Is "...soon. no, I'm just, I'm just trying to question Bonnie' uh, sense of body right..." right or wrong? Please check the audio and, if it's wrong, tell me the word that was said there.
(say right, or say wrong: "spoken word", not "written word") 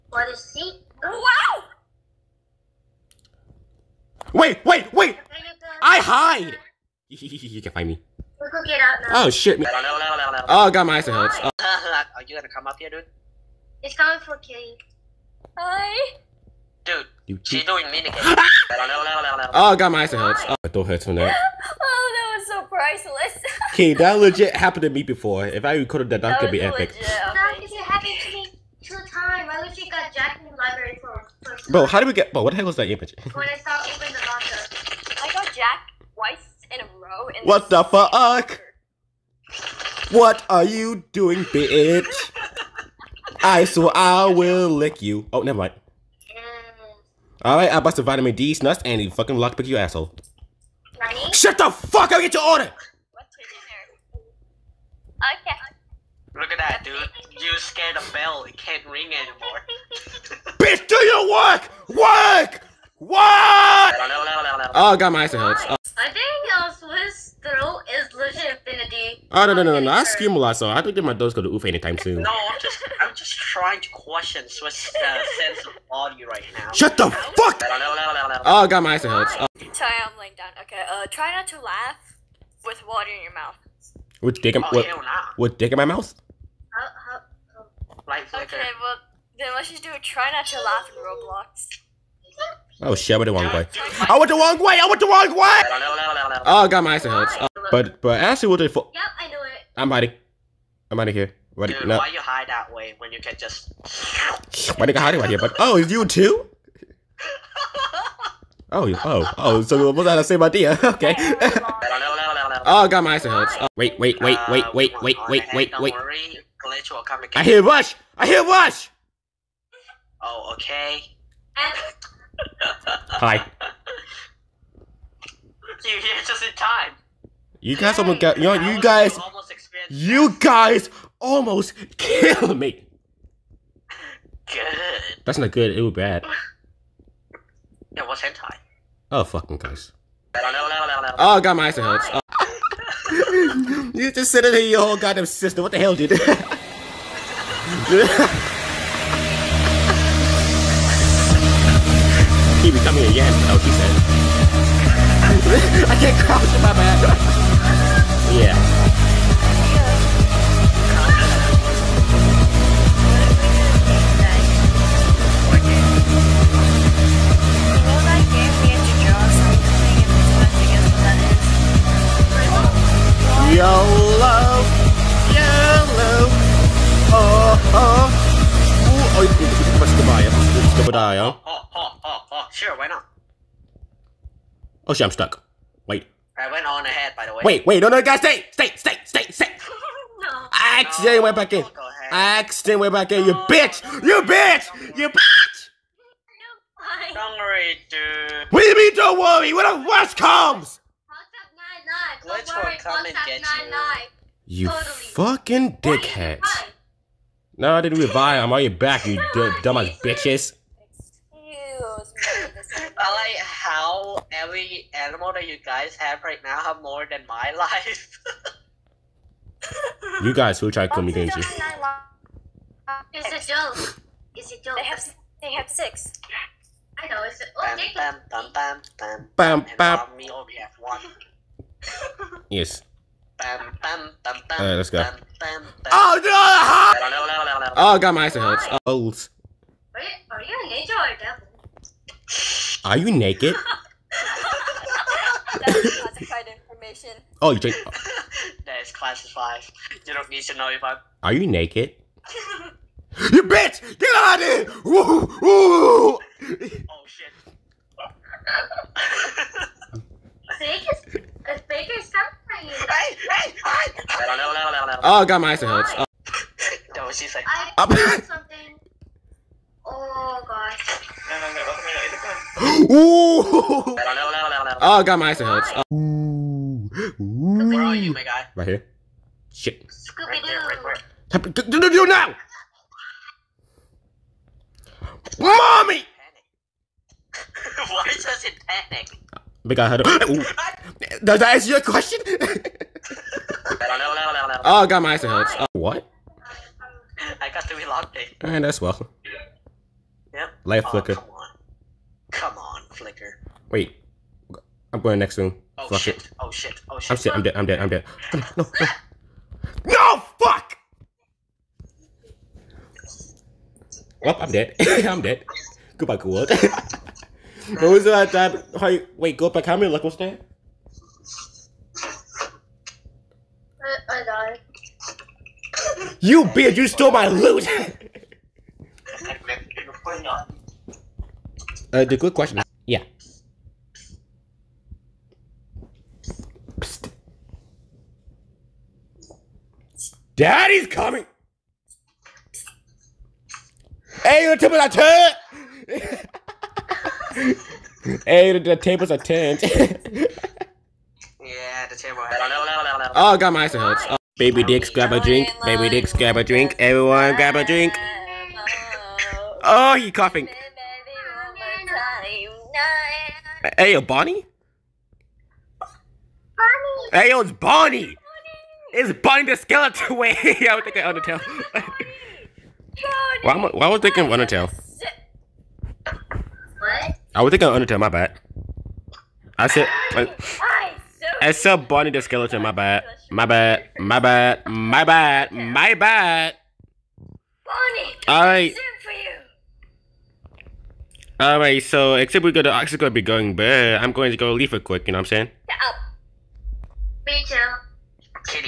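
wrong: "Swiss", not "Bonnie".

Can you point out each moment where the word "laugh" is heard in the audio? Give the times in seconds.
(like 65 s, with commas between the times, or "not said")
81 s, 90 s.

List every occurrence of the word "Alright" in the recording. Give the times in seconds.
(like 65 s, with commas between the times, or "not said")
233 s, 298 s.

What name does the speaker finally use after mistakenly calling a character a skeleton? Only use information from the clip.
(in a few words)
Barney.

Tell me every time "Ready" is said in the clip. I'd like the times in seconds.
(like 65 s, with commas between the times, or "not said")
50 s, 101 s.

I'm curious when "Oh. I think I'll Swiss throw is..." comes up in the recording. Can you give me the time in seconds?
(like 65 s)
65 s.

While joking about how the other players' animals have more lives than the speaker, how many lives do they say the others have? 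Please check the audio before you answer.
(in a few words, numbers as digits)
6.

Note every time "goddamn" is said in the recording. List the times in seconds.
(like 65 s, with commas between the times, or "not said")
144 s.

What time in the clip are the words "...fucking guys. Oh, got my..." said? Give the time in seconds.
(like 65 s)
139 s.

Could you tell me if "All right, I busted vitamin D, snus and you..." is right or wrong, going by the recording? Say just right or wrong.
right.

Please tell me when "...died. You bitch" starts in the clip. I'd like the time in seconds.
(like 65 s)
324 s.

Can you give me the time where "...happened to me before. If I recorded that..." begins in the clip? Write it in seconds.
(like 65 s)
24 s.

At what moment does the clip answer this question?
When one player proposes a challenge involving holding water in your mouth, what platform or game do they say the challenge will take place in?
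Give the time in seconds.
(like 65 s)
90 s.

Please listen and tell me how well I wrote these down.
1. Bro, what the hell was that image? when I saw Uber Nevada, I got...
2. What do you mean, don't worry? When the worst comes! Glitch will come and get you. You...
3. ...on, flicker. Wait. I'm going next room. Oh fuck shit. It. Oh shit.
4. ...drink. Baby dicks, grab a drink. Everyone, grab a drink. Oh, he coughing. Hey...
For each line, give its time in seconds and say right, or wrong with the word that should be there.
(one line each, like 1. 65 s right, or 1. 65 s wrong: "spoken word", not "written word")
1. 32 s right
2. 198 s right
3. 302 s right
4. 355 s right.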